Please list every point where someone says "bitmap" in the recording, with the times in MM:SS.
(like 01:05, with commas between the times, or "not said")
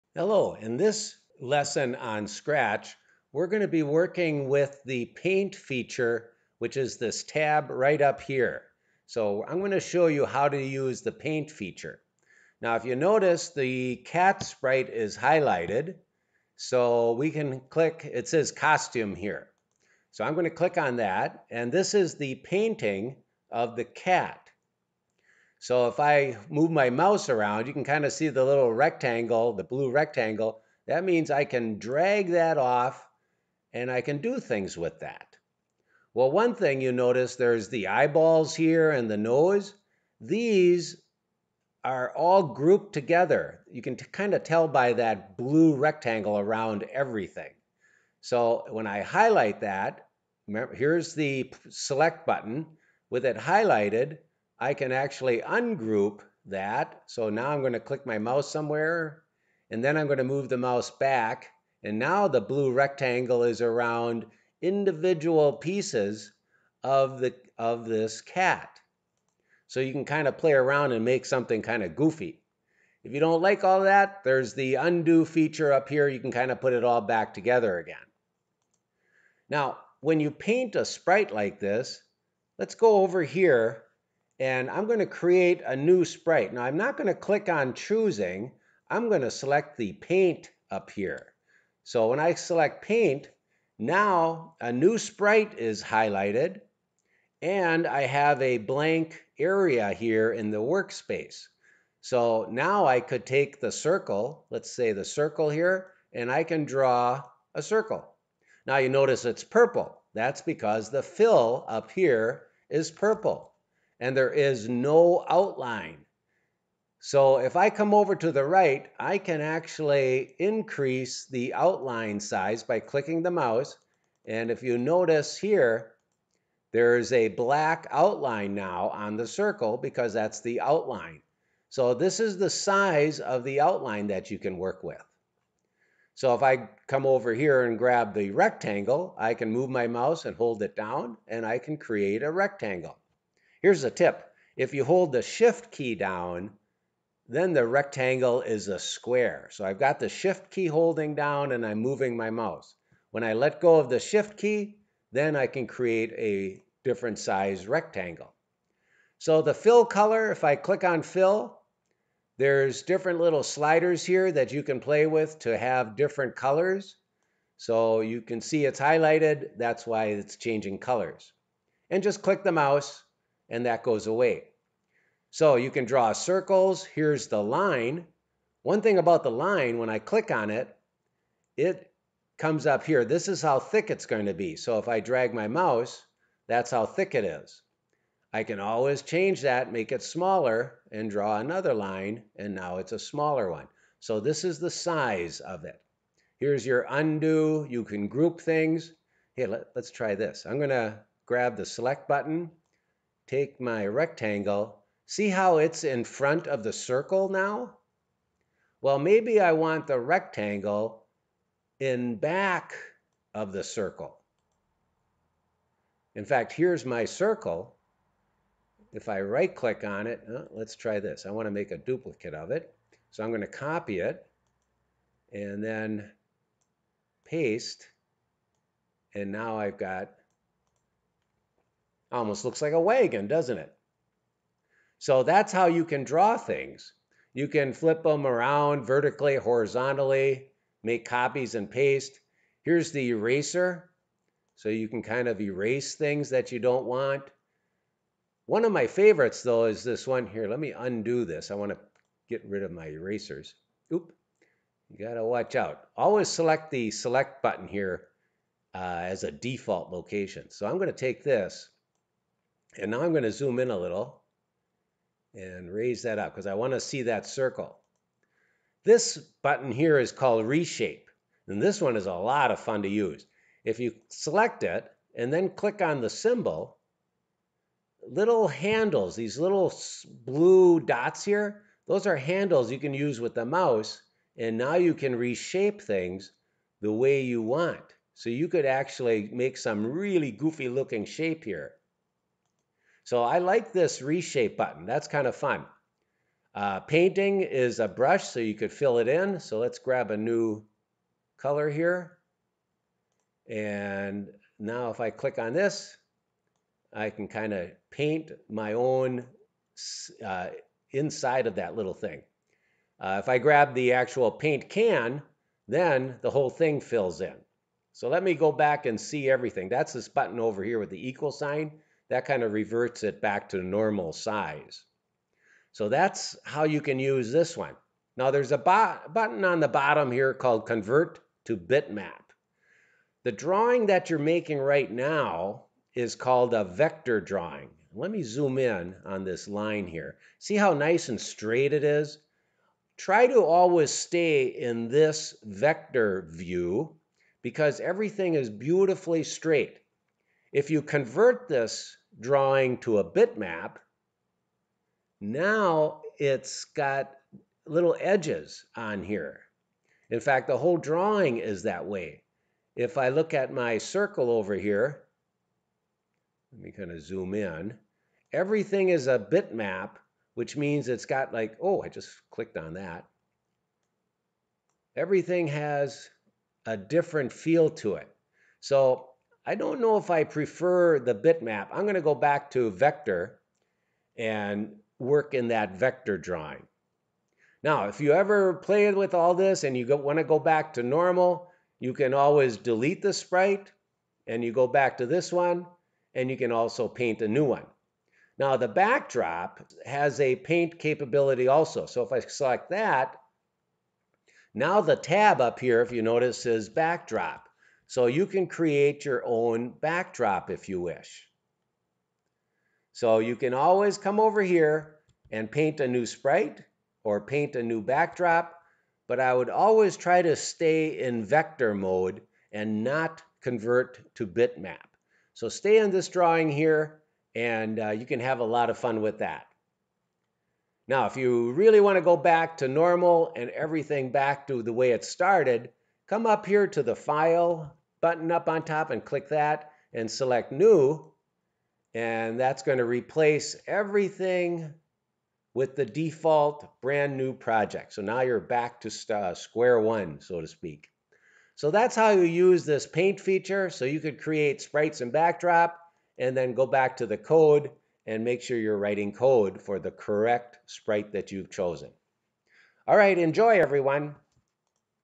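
05:31, 05:53, 06:09, 06:21, 07:04.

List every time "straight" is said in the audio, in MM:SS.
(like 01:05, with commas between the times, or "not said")
05:41, 05:49.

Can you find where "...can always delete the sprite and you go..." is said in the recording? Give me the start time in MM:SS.
06:31.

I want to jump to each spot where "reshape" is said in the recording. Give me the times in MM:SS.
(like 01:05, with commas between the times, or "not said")
04:30, 04:45, 04:54.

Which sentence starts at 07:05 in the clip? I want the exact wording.
So stay in this drawing here and uh, you can have a lot of fun with that.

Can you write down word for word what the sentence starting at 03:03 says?
This is how thick it's going to be.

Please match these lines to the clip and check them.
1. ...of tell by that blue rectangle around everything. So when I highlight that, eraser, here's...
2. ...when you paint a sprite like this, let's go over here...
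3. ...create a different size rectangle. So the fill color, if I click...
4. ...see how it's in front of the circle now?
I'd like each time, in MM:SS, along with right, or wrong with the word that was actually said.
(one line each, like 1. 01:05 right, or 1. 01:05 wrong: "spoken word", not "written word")
1. 00:44 wrong: "remember", not "eraser"
2. 01:20 right
3. 02:35 right
4. 03:25 right.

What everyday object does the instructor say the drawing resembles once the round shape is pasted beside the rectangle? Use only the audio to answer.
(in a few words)
A wagon.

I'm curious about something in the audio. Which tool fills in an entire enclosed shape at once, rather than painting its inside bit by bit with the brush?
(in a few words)
Paint can.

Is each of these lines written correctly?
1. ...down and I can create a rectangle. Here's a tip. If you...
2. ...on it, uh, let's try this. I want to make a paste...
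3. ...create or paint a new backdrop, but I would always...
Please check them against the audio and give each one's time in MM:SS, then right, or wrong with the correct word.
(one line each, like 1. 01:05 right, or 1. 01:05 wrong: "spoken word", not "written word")
1. 02:20 right
2. 03:39 wrong: "duplicate", not "paste"
3. 06:56 wrong: "sprite", not "create".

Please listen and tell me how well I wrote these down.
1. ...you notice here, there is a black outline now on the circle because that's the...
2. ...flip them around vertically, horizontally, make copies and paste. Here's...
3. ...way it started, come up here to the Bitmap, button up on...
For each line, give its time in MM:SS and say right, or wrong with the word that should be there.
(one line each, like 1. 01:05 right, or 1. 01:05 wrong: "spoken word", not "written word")
1. 02:04 right
2. 03:57 right
3. 07:14 wrong: "File", not "Bitmap".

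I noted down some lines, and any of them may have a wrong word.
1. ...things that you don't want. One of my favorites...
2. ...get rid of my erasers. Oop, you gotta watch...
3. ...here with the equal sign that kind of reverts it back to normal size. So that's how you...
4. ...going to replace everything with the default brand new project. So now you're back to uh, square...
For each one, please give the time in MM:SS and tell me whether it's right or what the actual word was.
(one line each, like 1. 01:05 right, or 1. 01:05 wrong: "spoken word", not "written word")
1. 04:05 right
2. 04:12 right
3. 05:20 right
4. 07:22 right.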